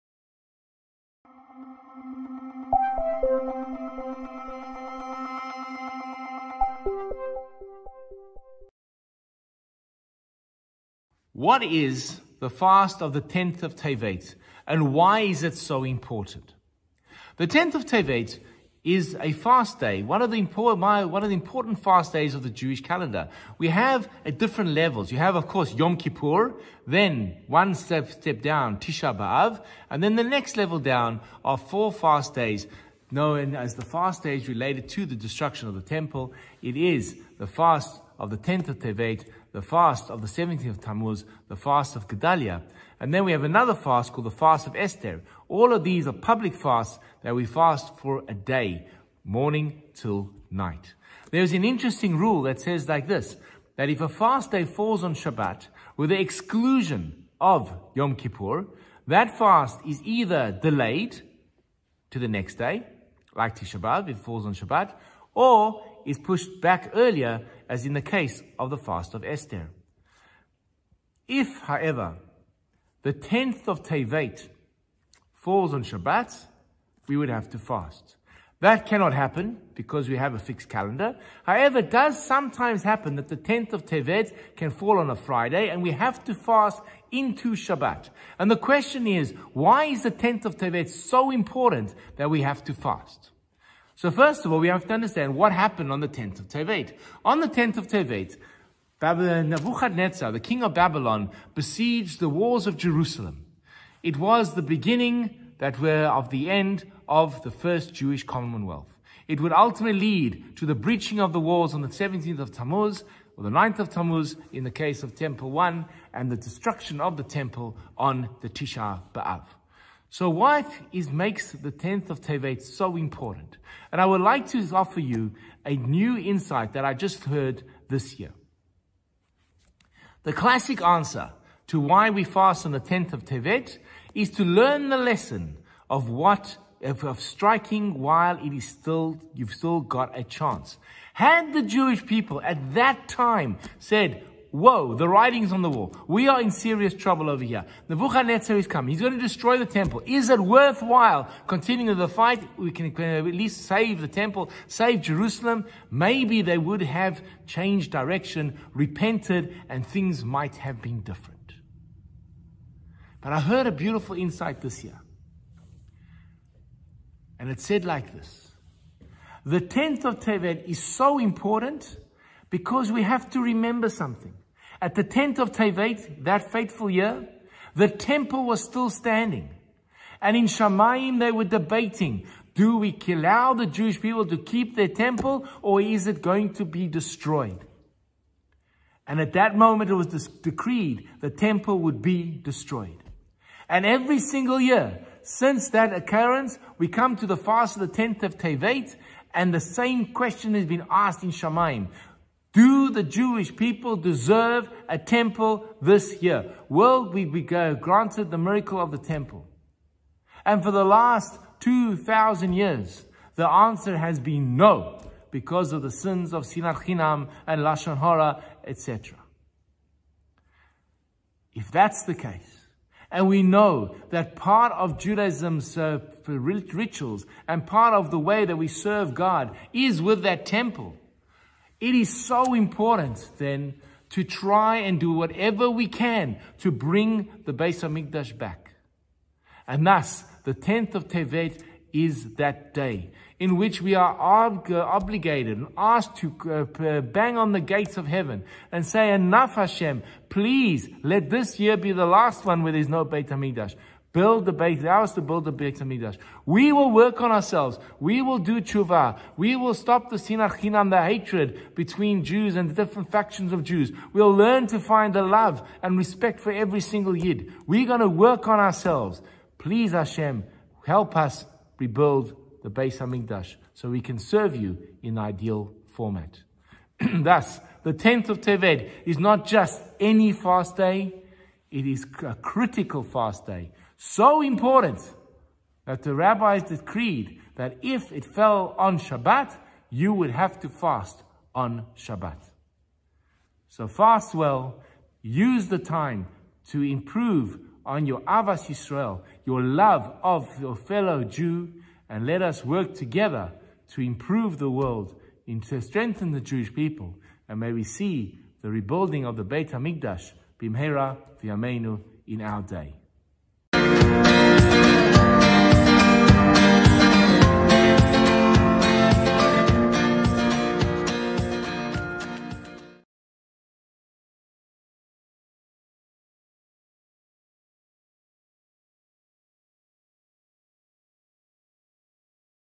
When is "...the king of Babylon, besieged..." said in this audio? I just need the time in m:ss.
1:40.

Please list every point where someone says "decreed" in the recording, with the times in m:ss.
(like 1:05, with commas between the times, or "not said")
3:10, 4:46.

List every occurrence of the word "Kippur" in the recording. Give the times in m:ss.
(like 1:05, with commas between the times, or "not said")
0:25, 0:58.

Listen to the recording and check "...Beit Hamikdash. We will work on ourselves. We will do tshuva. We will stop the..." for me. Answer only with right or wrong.
right.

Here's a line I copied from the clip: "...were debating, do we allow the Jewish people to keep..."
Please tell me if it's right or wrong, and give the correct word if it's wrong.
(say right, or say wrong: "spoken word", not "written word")
right.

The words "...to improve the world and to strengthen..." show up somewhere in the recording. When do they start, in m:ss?
5:03.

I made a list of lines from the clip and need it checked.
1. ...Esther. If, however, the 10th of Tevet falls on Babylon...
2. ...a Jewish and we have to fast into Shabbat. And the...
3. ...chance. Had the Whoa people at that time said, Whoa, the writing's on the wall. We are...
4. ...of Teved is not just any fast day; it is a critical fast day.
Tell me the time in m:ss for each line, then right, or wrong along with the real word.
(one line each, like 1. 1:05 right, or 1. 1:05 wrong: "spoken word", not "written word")
1. 1:09 wrong: "Shabbat", not "Babylon"
2. 1:25 wrong: "Friday", not "Jewish"
3. 2:20 wrong: "Jewish", not "Whoa"
4. 4:38 right.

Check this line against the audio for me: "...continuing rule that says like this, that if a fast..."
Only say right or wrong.
wrong.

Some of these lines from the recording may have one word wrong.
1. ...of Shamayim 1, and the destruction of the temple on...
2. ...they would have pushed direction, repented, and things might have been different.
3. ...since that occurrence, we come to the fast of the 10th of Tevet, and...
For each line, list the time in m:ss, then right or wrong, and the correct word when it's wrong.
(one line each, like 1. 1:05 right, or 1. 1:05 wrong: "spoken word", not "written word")
1. 1:55 wrong: "Temple", not "Shamayim"
2. 2:36 wrong: "changed", not "pushed"
3. 3:15 right.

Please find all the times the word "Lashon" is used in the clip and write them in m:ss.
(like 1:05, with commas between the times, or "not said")
3:37.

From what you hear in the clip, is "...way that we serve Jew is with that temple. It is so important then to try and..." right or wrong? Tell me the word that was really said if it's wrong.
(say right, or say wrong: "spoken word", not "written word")
wrong: "God", not "Jew".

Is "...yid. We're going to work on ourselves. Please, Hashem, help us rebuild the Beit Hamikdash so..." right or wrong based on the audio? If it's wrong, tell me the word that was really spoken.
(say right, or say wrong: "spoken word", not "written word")
right.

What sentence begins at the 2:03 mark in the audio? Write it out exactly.
And I would like to offer you a new insight that I just heard this year.